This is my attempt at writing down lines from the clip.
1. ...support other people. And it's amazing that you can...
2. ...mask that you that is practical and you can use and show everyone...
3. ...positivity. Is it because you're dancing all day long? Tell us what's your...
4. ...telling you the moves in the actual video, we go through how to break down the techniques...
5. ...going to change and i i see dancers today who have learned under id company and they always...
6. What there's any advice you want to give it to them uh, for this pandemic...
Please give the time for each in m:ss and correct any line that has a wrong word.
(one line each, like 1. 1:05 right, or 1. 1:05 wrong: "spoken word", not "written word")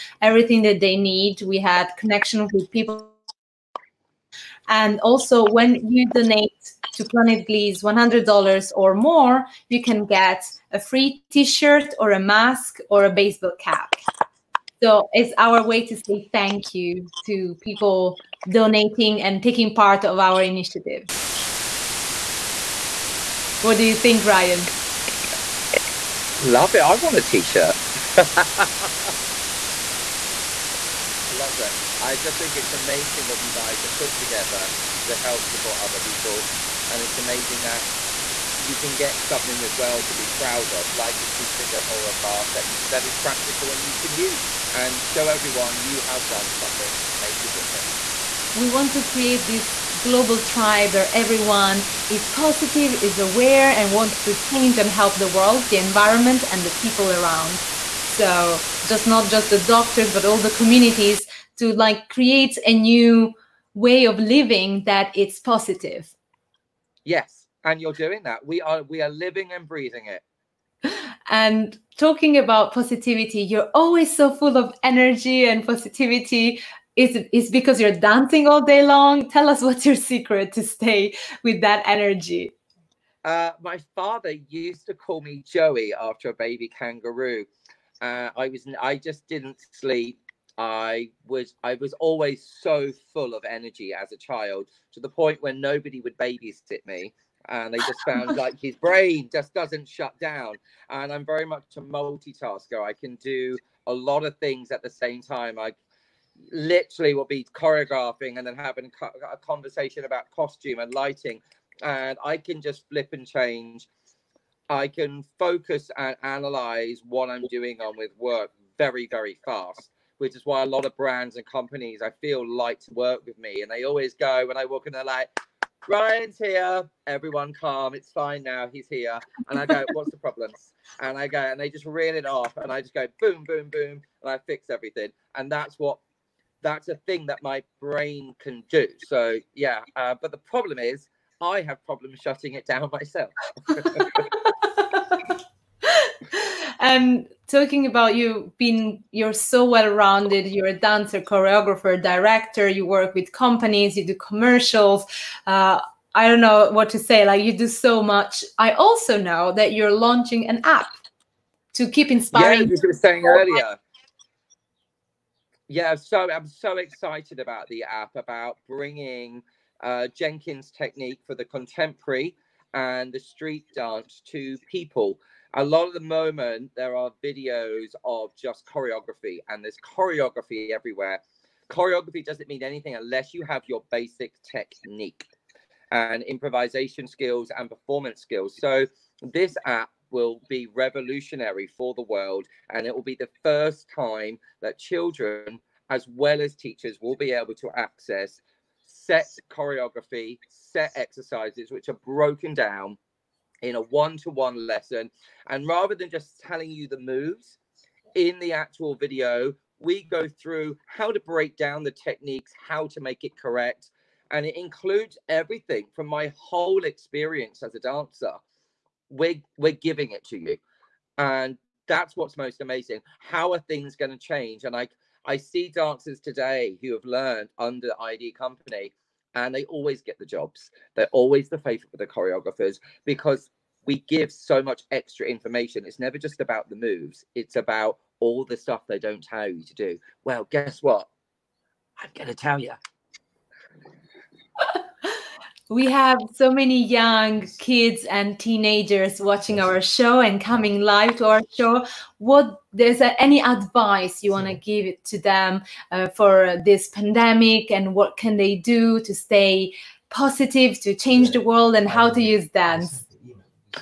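1. 0:35 right
2. 0:42 right
3. 1:15 right
4. 3:26 right
5. 3:43 right
6. 4:12 right.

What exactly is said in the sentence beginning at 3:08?
So, this app will be revolutionary for the world.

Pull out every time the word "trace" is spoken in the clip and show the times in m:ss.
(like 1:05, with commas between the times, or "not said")
not said.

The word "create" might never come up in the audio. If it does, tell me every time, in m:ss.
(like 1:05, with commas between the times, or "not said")
0:49, 1:02.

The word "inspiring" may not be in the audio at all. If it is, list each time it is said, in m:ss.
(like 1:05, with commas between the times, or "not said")
2:42.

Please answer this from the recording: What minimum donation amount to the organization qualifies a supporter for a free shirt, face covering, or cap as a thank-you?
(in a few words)
$100.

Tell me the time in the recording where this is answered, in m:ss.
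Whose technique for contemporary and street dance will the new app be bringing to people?
2:50.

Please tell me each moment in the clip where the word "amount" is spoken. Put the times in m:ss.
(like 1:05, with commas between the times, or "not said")
not said.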